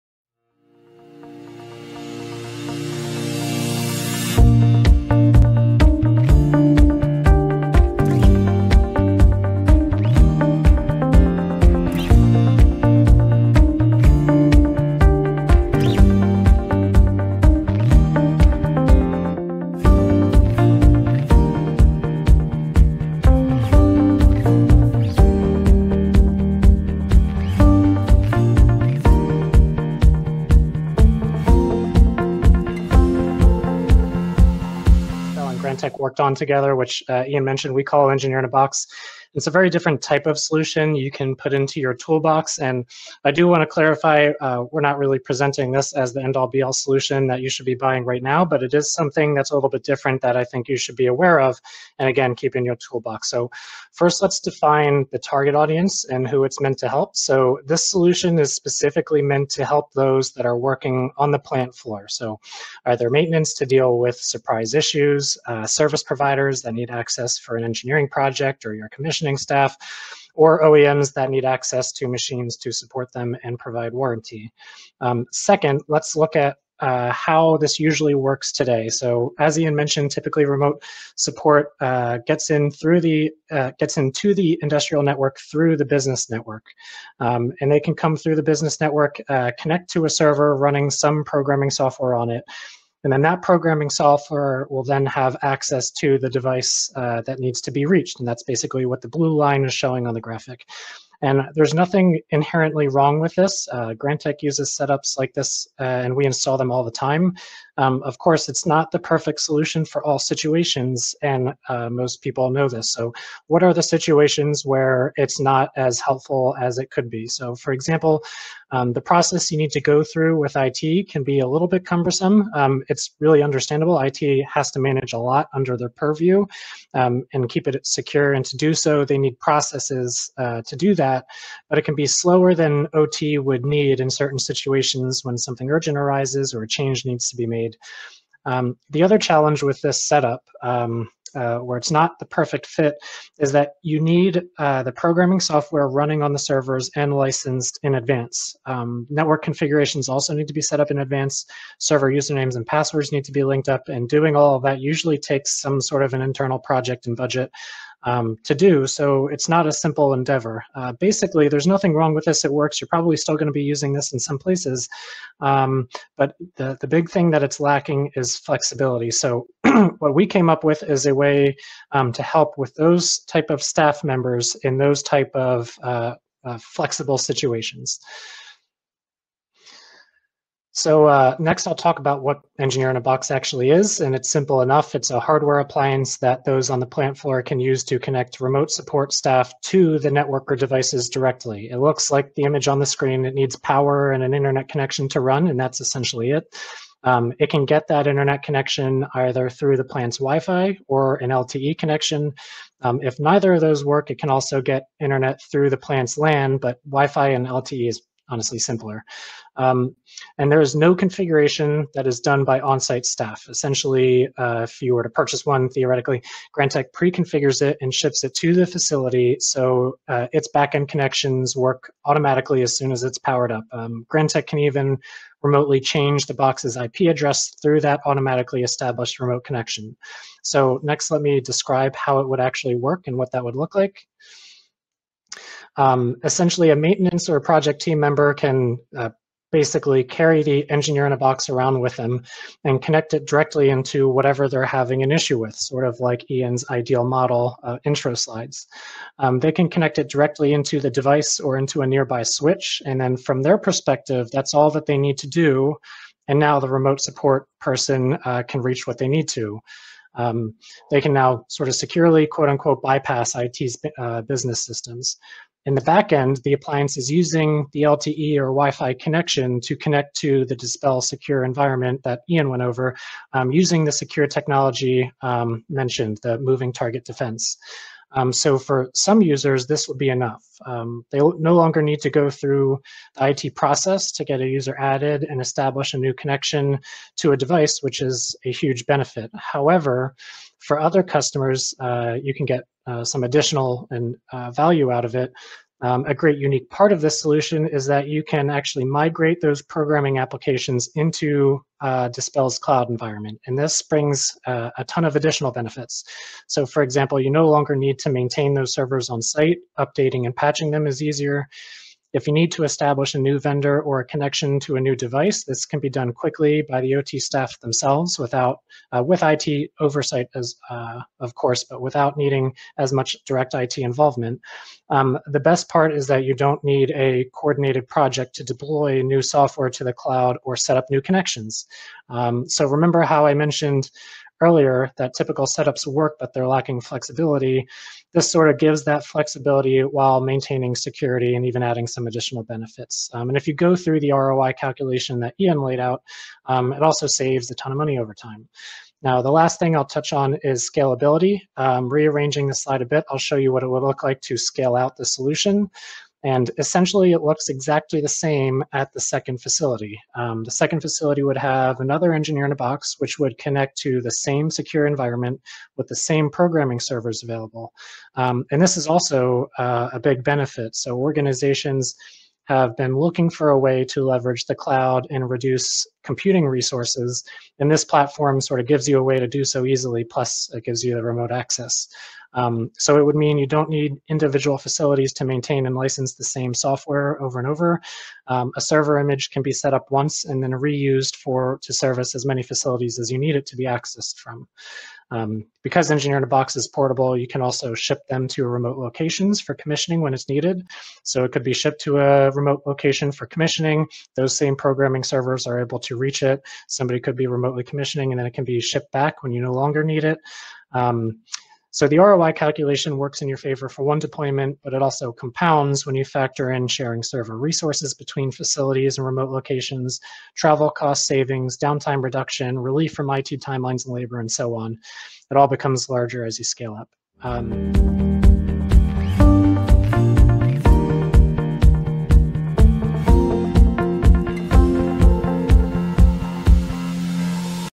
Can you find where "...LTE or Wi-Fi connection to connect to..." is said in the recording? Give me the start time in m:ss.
4:27.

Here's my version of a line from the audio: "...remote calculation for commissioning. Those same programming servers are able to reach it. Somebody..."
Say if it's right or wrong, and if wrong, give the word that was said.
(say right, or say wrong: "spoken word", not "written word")
wrong: "location", not "calculation".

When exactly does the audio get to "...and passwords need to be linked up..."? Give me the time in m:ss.
2:32.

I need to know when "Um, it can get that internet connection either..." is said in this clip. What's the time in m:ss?
3:17.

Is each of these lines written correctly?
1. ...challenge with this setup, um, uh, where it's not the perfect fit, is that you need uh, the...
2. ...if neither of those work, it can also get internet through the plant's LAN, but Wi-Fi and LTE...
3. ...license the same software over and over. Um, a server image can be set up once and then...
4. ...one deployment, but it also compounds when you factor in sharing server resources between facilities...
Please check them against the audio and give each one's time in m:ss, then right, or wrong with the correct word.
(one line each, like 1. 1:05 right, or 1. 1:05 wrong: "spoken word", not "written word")
1. 2:19 right
2. 3:23 right
3. 6:25 right
4. 6:53 right.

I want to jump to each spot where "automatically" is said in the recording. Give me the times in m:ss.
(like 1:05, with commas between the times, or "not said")
3:42, 3:48.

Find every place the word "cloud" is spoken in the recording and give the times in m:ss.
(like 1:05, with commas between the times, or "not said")
5:02, 5:29, 6:14.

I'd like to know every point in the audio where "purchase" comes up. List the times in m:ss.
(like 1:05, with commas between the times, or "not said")
3:35.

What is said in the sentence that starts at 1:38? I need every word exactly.
And that's basically what the blue line is showing on the graphic.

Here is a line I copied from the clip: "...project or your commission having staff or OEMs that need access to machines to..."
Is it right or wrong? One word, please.
wrong.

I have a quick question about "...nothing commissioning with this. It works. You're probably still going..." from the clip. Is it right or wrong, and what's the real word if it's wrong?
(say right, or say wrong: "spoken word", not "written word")
wrong: "wrong", not "commissioning".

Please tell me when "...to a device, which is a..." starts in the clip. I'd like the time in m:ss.
4:47.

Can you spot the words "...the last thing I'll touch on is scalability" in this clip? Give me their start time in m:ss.
5:49.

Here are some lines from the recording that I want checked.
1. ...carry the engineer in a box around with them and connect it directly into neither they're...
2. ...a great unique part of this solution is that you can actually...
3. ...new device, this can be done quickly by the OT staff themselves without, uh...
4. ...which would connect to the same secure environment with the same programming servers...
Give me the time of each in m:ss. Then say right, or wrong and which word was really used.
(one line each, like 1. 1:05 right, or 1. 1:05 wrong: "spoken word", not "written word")
1. 4:00 wrong: "whatever", not "neither"
2. 4:56 right
3. 5:14 right
4. 6:02 right.